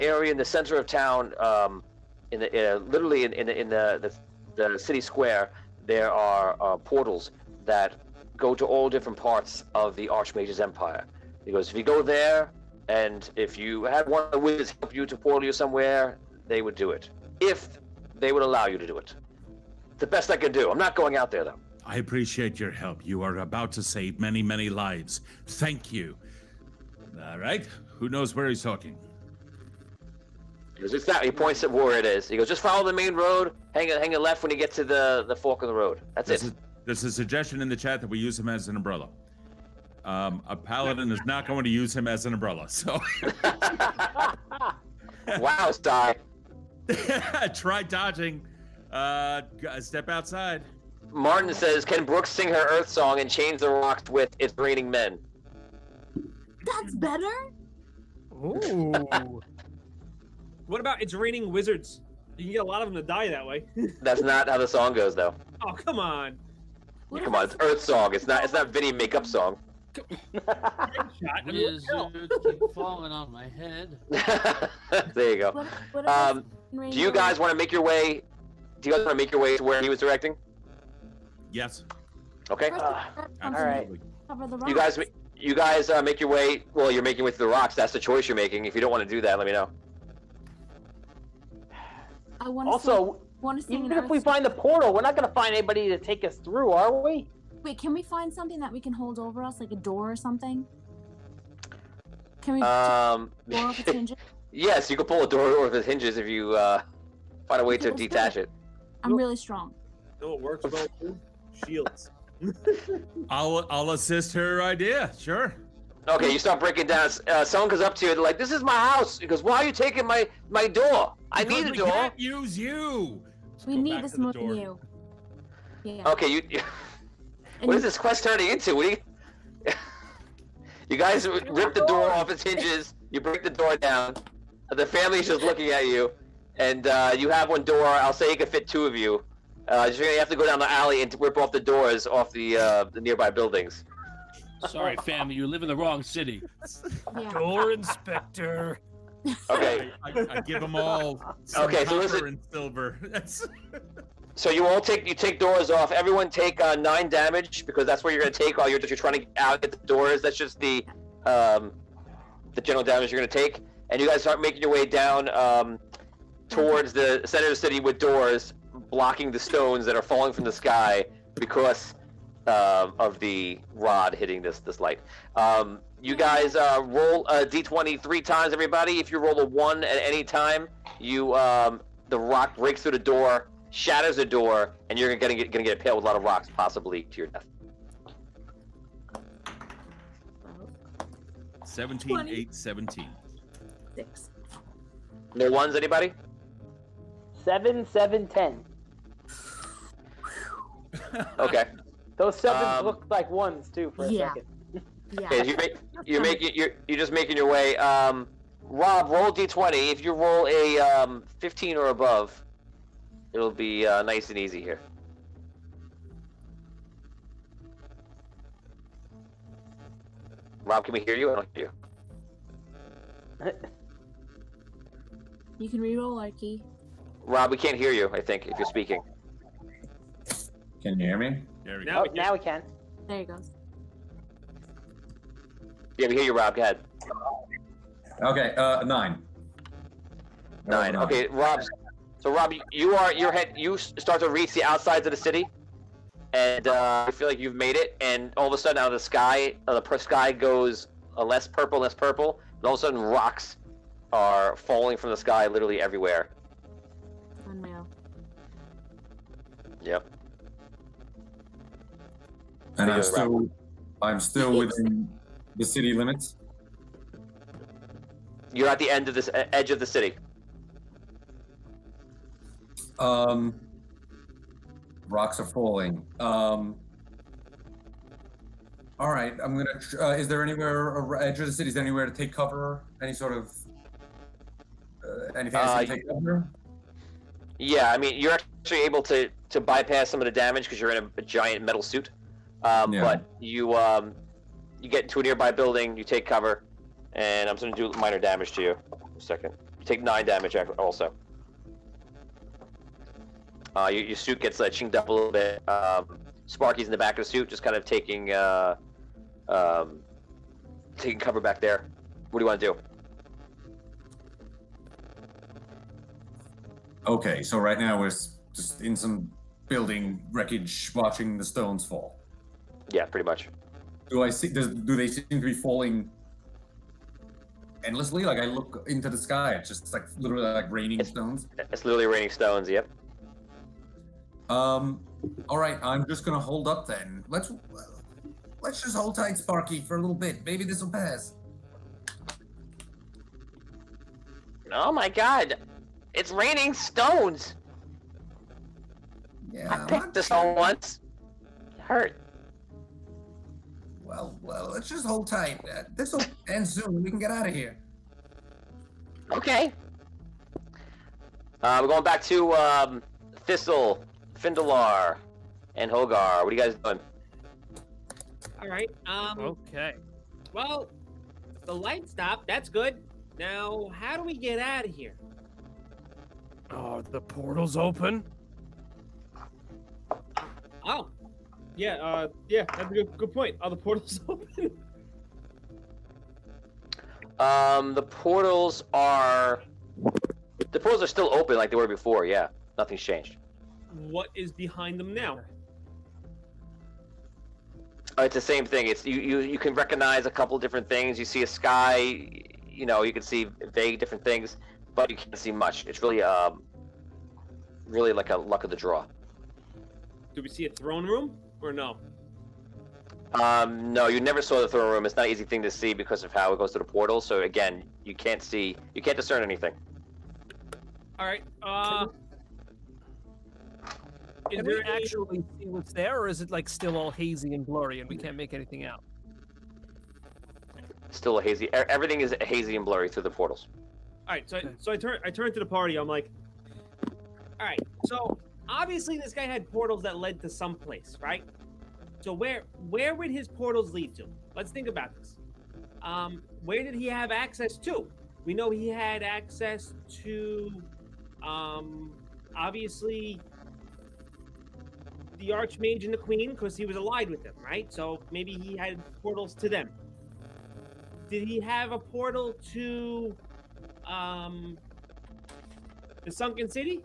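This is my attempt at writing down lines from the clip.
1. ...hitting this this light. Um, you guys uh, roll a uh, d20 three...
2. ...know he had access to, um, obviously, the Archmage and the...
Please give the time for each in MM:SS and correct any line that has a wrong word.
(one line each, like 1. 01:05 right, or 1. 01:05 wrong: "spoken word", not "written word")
1. 02:54 right
2. 07:28 right.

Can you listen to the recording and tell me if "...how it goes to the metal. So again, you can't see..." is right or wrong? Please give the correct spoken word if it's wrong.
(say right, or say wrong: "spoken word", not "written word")
wrong: "portal", not "metal".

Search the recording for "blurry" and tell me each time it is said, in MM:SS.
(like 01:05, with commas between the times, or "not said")
07:07, 07:12.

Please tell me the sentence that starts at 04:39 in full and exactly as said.
Uh, is there anywhere edge of the city?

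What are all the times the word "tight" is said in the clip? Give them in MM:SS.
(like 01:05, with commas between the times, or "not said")
05:39, 05:55.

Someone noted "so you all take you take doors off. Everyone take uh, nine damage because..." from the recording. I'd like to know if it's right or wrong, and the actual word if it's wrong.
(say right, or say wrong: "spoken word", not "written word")
right.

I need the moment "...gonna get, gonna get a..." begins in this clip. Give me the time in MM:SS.
03:05.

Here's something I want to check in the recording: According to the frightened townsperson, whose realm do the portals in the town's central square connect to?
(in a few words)
The Archmage's empire.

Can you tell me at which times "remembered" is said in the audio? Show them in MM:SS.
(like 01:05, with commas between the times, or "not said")
not said.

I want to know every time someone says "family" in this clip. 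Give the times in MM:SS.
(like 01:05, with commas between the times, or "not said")
02:14, 02:25.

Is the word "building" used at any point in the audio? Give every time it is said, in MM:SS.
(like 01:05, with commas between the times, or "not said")
02:23, 04:55, 05:19.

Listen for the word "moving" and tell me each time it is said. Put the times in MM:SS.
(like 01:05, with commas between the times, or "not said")
not said.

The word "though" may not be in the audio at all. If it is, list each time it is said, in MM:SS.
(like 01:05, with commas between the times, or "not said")
00:21, 01:05.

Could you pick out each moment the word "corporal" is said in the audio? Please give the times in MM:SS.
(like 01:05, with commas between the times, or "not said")
not said.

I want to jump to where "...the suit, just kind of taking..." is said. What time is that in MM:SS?
05:07.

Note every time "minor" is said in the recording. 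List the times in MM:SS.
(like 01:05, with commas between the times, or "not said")
04:57.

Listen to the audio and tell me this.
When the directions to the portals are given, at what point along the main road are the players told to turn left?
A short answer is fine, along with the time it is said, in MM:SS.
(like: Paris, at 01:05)
The fork of the road, at 00:35.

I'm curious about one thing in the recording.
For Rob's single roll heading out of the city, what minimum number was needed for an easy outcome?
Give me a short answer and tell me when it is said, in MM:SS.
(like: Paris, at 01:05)
15, at 03:31.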